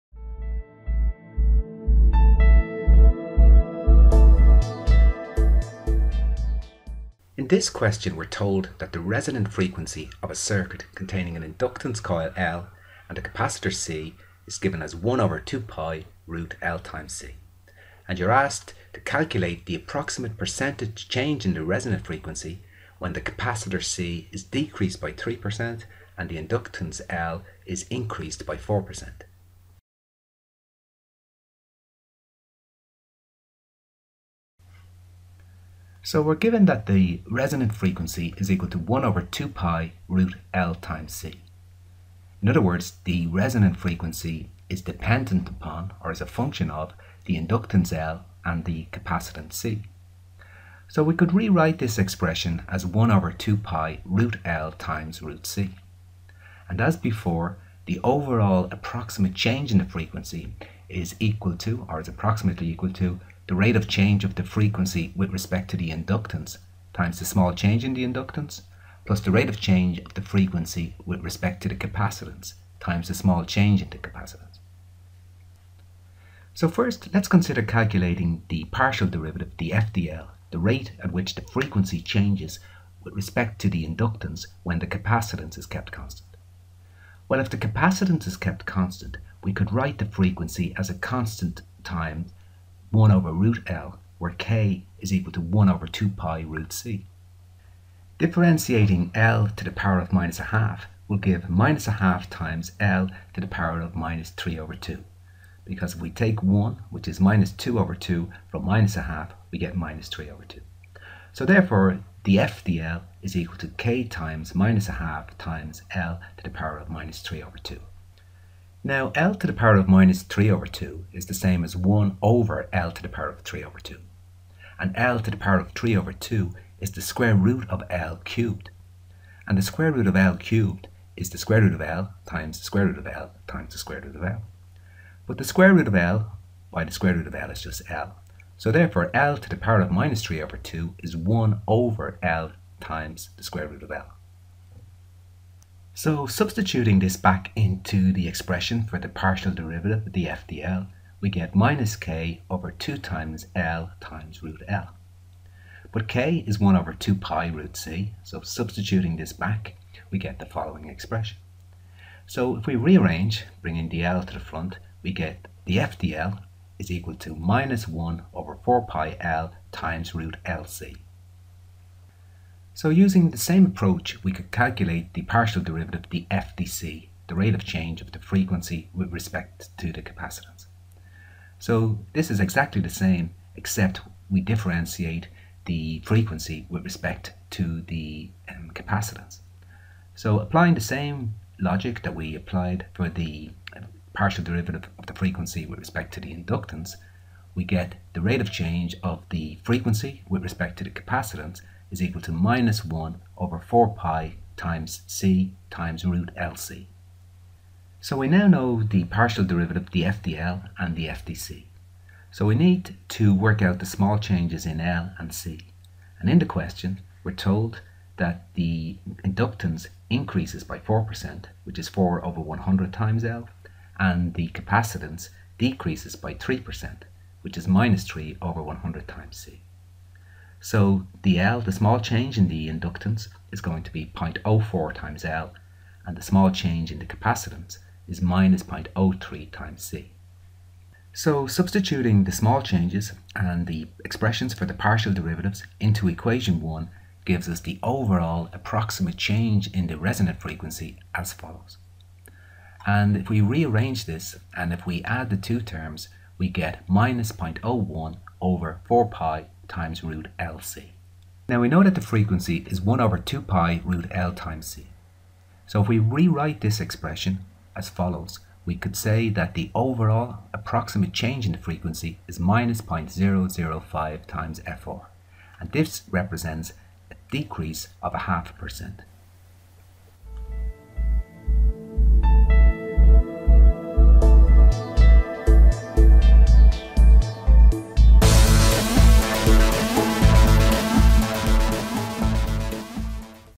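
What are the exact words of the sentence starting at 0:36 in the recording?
So we're given that the resonant frequency is equal to 1 over 2 pi root L times C.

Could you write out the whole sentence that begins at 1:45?
Because if we take 1, which is minus 2 over 2, from minus a half, we get minus 3 over 2.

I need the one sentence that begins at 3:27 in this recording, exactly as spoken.
So we now know the partial derivative, the FDL and the FDC.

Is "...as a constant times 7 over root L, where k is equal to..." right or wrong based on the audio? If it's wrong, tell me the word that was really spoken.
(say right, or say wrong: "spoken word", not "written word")
wrong: "1", not "7".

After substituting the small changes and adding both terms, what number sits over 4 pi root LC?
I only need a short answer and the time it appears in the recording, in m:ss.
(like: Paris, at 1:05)
-0.01, at 4:16.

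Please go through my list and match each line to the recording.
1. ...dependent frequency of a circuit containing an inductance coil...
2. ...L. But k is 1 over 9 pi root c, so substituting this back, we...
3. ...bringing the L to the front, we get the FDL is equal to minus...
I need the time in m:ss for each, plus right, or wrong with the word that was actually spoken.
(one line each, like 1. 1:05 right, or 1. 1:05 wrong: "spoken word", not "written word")
1. 0:09 wrong: "resonant", not "dependent"
2. 2:34 wrong: "2", not "9"
3. 2:43 right.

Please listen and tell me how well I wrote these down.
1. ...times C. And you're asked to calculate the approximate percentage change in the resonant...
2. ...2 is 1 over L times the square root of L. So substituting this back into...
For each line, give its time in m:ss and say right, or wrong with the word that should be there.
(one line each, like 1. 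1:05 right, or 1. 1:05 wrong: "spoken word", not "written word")
1. 0:16 right
2. 2:20 right.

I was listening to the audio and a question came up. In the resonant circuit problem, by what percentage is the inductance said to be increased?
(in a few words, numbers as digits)
4%.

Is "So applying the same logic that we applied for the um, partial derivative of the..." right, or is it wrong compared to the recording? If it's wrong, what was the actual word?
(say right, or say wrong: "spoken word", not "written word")
right.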